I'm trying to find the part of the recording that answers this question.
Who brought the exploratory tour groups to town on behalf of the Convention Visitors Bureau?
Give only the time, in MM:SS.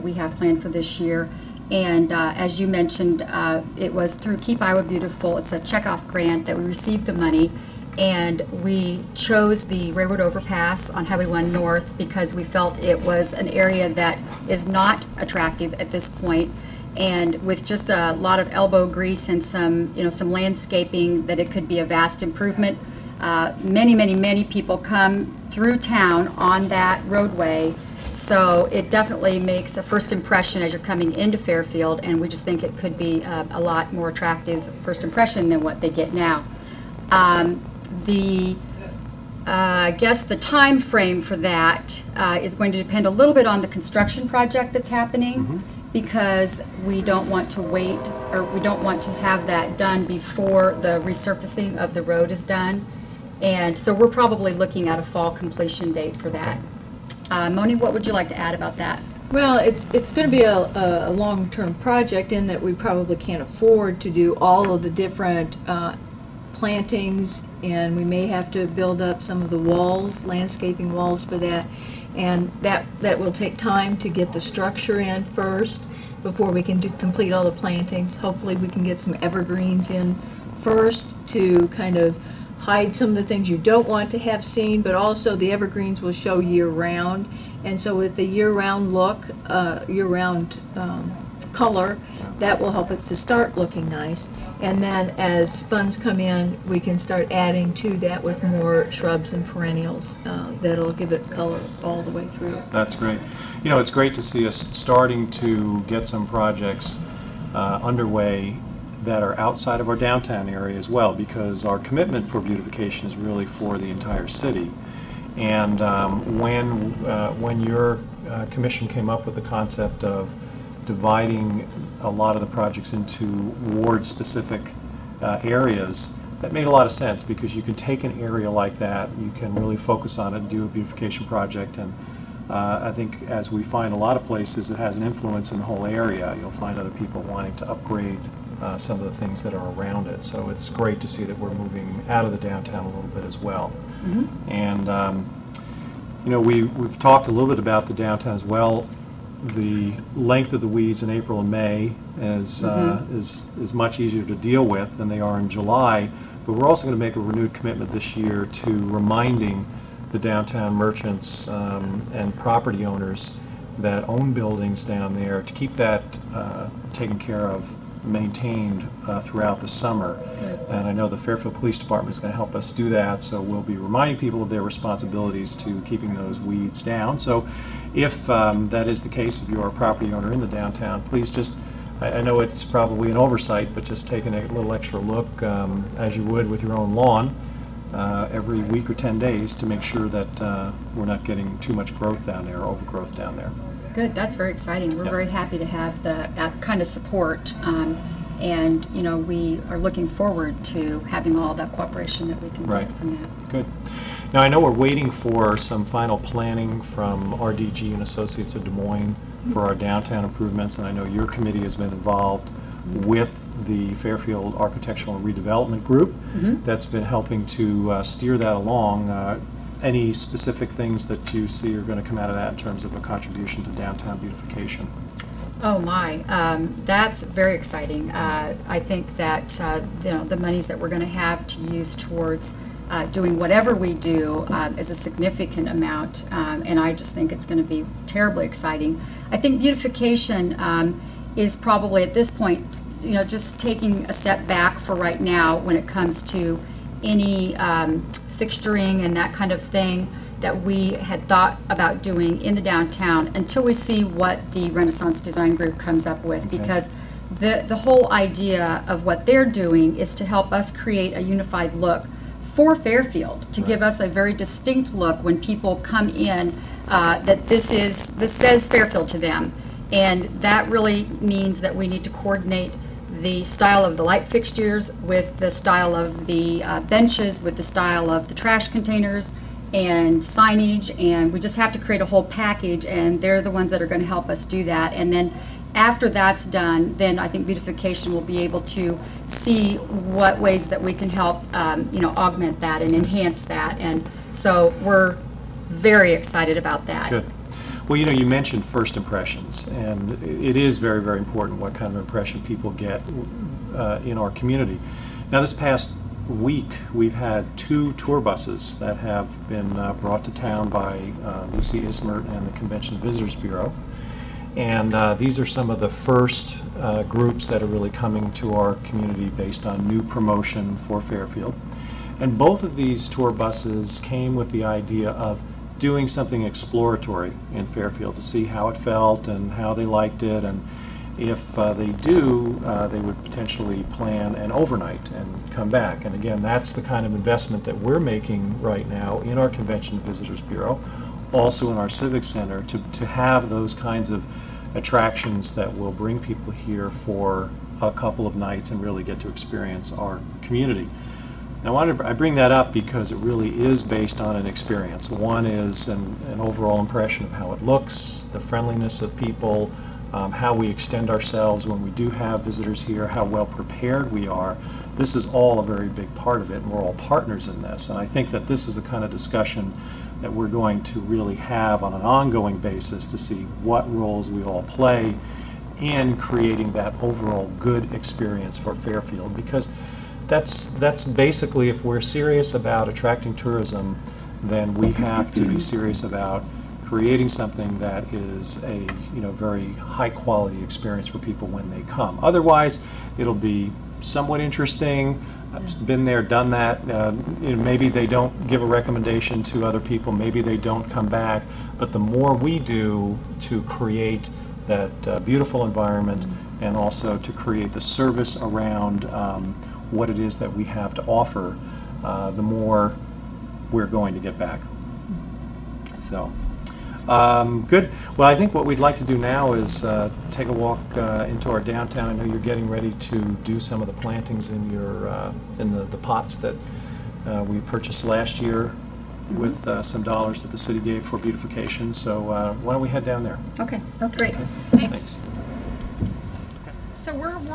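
05:11.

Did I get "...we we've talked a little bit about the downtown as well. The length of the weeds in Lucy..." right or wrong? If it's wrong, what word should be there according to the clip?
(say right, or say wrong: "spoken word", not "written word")
wrong: "April", not "Lucy".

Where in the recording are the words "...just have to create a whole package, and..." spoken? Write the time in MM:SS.
04:41.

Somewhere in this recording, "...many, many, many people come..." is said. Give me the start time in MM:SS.
00:23.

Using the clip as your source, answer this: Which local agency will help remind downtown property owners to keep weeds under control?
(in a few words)
Fairfield Police Department.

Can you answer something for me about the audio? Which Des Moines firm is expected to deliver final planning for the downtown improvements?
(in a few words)
RDG and Associates.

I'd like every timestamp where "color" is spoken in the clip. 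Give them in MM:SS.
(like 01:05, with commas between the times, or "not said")
01:31, 01:41.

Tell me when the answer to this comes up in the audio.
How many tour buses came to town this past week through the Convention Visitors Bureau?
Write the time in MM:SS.
05:07.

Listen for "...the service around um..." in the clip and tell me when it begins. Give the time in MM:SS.
06:47.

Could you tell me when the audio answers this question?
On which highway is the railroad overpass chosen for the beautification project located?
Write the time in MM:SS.
00:11.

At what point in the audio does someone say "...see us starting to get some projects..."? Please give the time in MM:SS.
01:44.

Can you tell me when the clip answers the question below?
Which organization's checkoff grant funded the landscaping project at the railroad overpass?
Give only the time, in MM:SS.
00:04.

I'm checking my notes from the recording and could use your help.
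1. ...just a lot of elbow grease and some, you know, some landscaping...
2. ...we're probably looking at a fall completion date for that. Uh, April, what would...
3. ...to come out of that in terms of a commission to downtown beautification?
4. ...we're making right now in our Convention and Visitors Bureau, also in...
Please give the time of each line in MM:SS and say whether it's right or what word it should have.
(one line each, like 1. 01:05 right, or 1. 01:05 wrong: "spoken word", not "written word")
1. 00:17 right
2. 00:53 wrong: "Moni", not "April"
3. 03:42 wrong: "contribution", not "commission"
4. 05:37 right.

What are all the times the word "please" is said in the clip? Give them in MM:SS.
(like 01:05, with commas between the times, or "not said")
03:01.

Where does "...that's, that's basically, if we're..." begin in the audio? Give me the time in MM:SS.
06:20.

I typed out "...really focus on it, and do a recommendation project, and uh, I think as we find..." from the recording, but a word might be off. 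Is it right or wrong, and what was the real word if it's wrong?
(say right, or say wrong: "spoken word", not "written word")
wrong: "beautification", not "recommendation".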